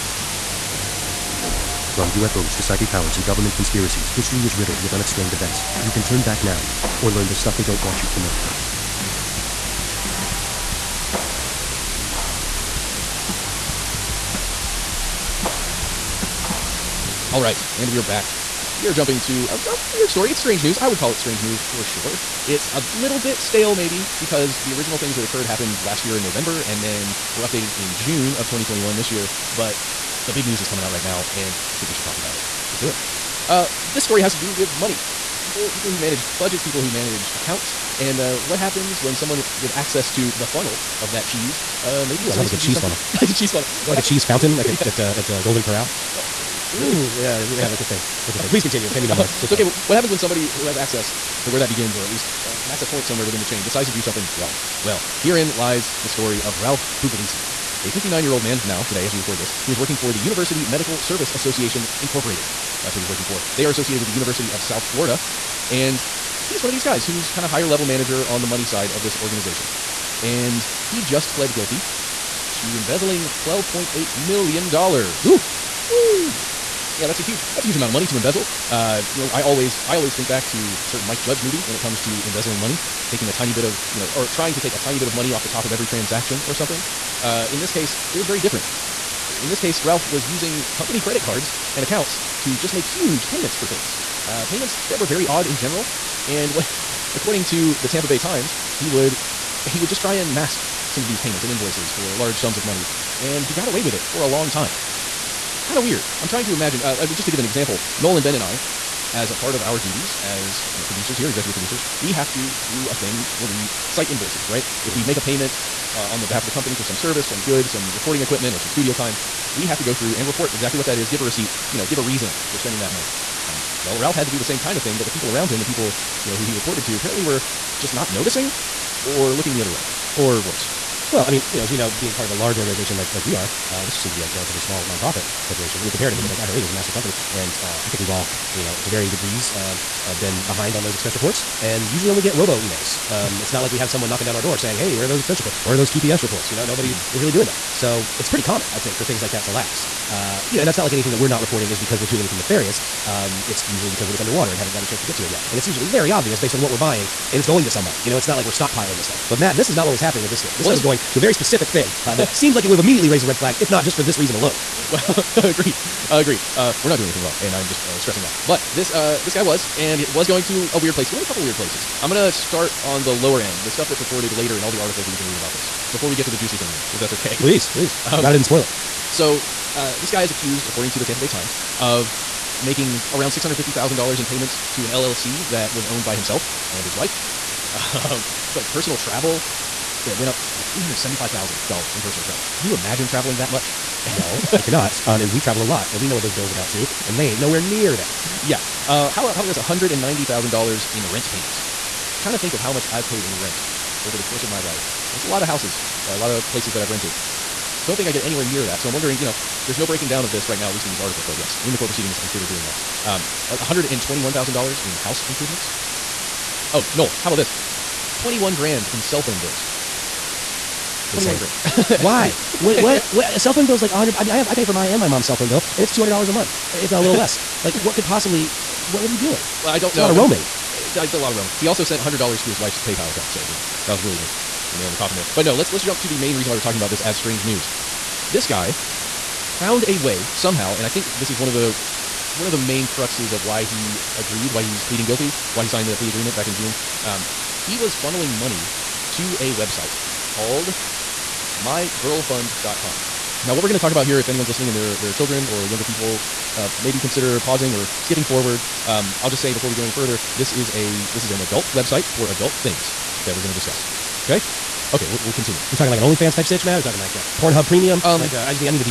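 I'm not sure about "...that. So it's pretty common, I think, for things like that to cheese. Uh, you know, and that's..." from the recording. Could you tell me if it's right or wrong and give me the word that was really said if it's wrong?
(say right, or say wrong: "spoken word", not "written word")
wrong: "lapse", not "cheese".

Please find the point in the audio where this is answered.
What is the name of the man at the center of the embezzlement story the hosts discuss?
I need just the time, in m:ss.
0:56.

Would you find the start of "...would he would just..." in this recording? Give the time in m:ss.
1:38.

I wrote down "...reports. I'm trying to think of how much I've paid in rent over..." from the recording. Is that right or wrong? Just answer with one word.
wrong.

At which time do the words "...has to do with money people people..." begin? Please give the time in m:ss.
0:34.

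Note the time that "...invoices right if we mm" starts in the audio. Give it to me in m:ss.
1:54.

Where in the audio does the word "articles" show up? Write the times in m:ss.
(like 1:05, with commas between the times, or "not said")
2:54, 3:30.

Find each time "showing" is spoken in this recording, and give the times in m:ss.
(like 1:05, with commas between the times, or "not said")
not said.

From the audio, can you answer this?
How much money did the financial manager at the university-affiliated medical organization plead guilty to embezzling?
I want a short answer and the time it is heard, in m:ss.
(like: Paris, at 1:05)
$12.8 million, at 1:13.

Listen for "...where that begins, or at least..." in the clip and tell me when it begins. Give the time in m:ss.
0:51.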